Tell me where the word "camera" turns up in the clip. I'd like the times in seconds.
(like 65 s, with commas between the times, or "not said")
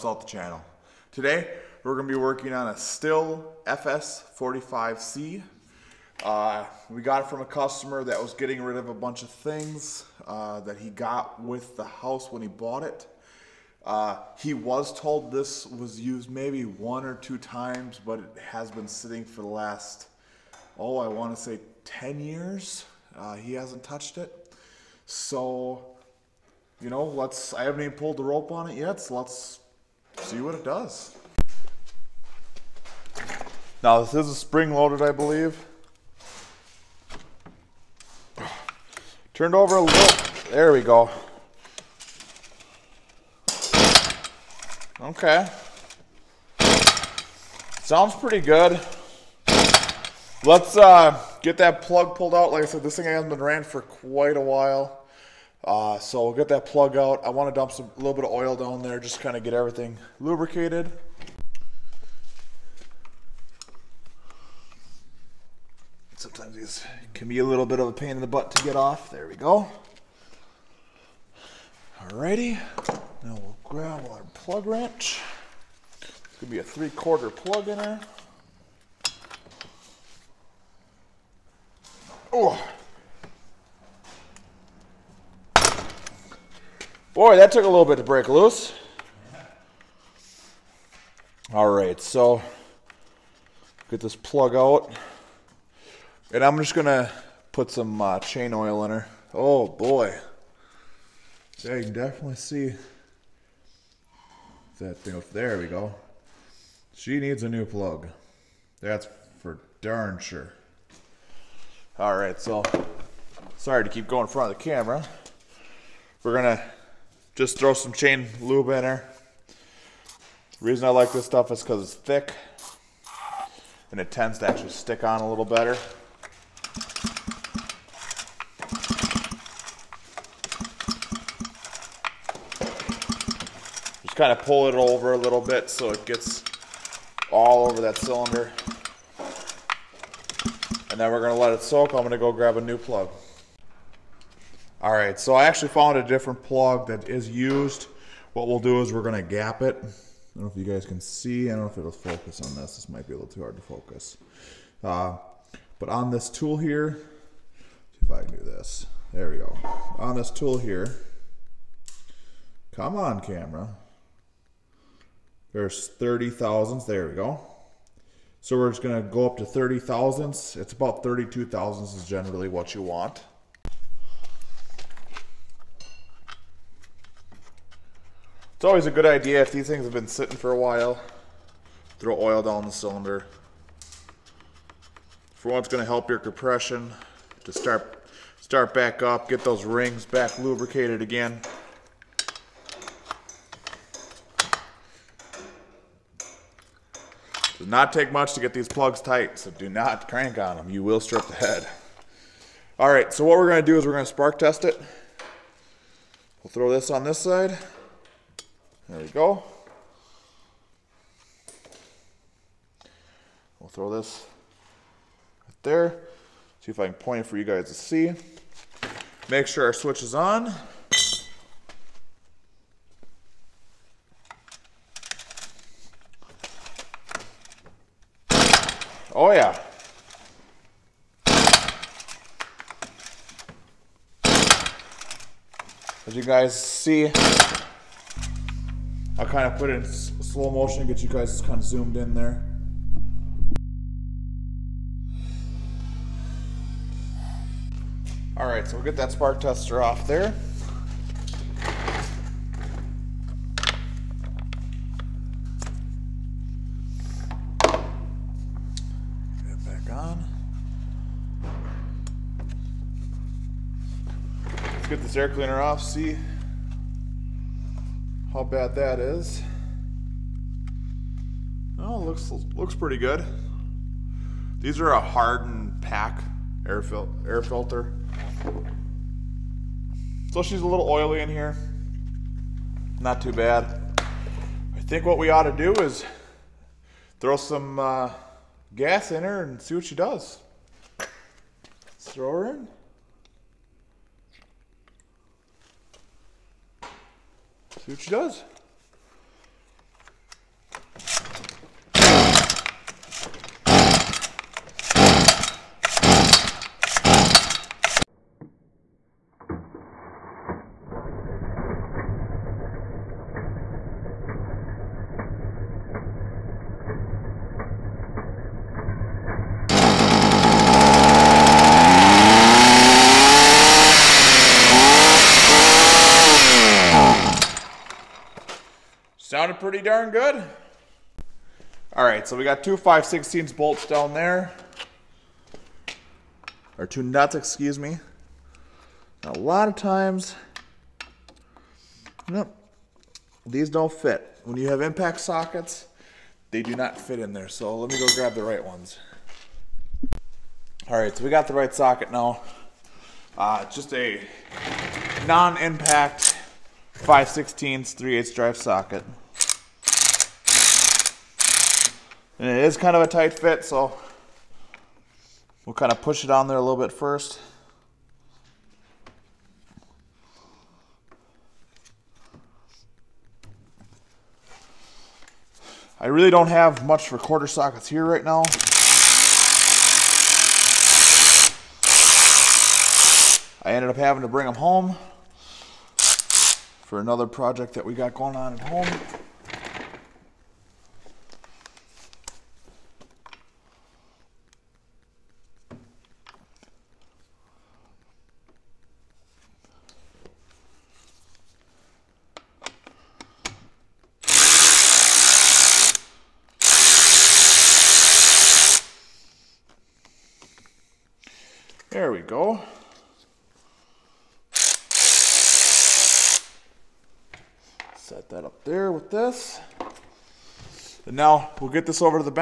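114 s, 163 s.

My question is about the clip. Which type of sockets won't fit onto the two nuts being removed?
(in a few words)
impact sockets.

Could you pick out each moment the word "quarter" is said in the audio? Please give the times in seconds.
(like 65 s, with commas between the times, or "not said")
76 s, 377 s.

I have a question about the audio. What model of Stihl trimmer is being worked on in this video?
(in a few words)
FS45C.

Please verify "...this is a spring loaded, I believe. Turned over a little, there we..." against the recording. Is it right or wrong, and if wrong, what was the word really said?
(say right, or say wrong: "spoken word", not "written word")
right.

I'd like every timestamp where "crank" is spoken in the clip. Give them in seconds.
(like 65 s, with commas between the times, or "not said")
200 s.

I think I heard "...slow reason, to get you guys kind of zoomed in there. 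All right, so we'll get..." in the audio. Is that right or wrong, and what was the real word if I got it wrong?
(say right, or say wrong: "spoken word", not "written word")
wrong: "motion", not "reason".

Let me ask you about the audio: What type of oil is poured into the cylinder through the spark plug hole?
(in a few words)
chain oil.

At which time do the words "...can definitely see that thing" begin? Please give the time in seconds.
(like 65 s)
101 s.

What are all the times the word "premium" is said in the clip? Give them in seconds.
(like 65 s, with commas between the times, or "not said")
not said.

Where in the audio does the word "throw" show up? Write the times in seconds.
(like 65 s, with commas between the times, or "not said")
117 s, 181 s, 206 s, 213 s, 287 s, 292 s.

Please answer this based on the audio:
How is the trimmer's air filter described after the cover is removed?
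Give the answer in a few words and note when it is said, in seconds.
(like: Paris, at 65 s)
hardened pack, at 274 s.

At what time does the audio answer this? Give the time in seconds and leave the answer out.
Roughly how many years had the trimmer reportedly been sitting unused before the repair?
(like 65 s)
21 s.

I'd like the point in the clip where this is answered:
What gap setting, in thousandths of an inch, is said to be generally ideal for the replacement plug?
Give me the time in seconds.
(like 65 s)
171 s.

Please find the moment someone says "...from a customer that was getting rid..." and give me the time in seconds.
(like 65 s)
7 s.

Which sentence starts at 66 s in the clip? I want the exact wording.
Sometimes these can be a little bit of a pain in the butt to get off.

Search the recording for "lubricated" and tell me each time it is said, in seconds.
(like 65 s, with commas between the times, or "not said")
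60 s, 190 s.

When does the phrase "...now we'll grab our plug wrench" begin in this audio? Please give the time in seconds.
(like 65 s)
73 s.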